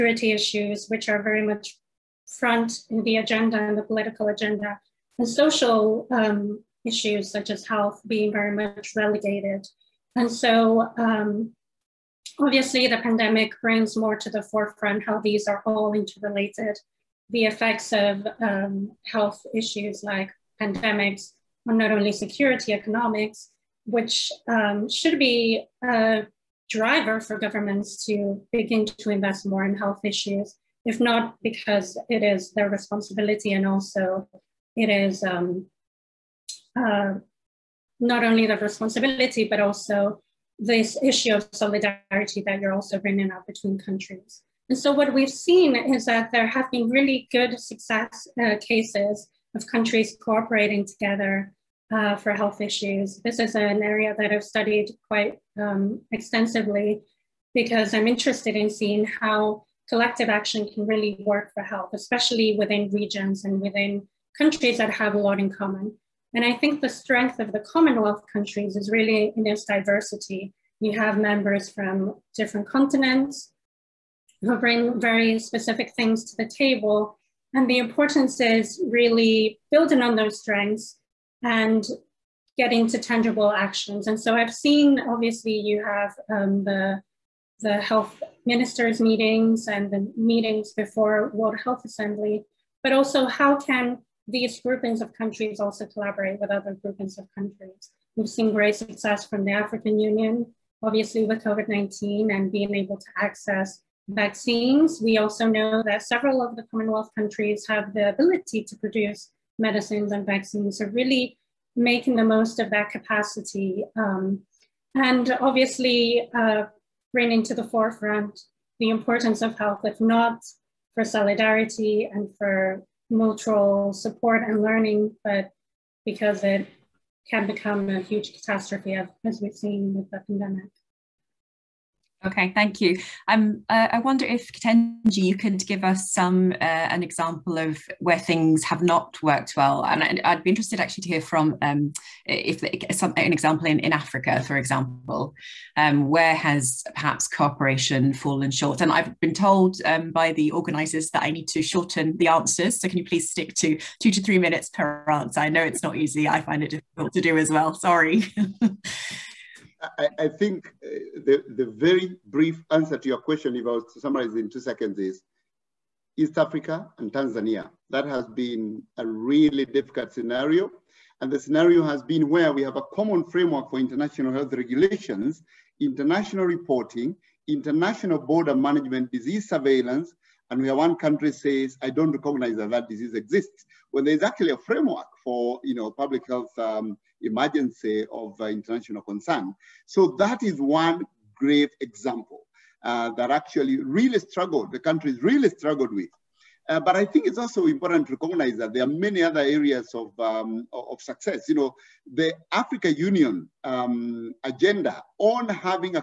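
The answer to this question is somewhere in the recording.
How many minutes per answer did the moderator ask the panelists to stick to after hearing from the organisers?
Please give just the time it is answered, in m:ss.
2:34.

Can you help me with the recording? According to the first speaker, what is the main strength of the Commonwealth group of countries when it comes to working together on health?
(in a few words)
Its diversity.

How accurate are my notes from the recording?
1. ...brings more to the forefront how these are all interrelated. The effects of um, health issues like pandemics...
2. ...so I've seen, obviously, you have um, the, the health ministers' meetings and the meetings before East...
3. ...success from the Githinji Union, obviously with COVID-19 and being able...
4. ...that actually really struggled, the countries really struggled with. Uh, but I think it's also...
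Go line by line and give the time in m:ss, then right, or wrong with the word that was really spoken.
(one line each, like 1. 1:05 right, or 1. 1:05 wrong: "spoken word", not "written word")
1. 0:13 right
2. 1:24 wrong: "World", not "East"
3. 1:38 wrong: "African", not "Githinji"
4. 3:13 right.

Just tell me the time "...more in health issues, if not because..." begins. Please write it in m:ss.
0:29.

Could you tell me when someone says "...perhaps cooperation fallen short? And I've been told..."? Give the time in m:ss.
2:26.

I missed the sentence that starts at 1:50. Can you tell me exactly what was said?
are really making the most of that capacity.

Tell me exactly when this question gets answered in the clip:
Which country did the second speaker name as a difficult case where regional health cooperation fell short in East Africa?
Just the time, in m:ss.
2:47.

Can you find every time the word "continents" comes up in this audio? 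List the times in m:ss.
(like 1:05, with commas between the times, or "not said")
1:12.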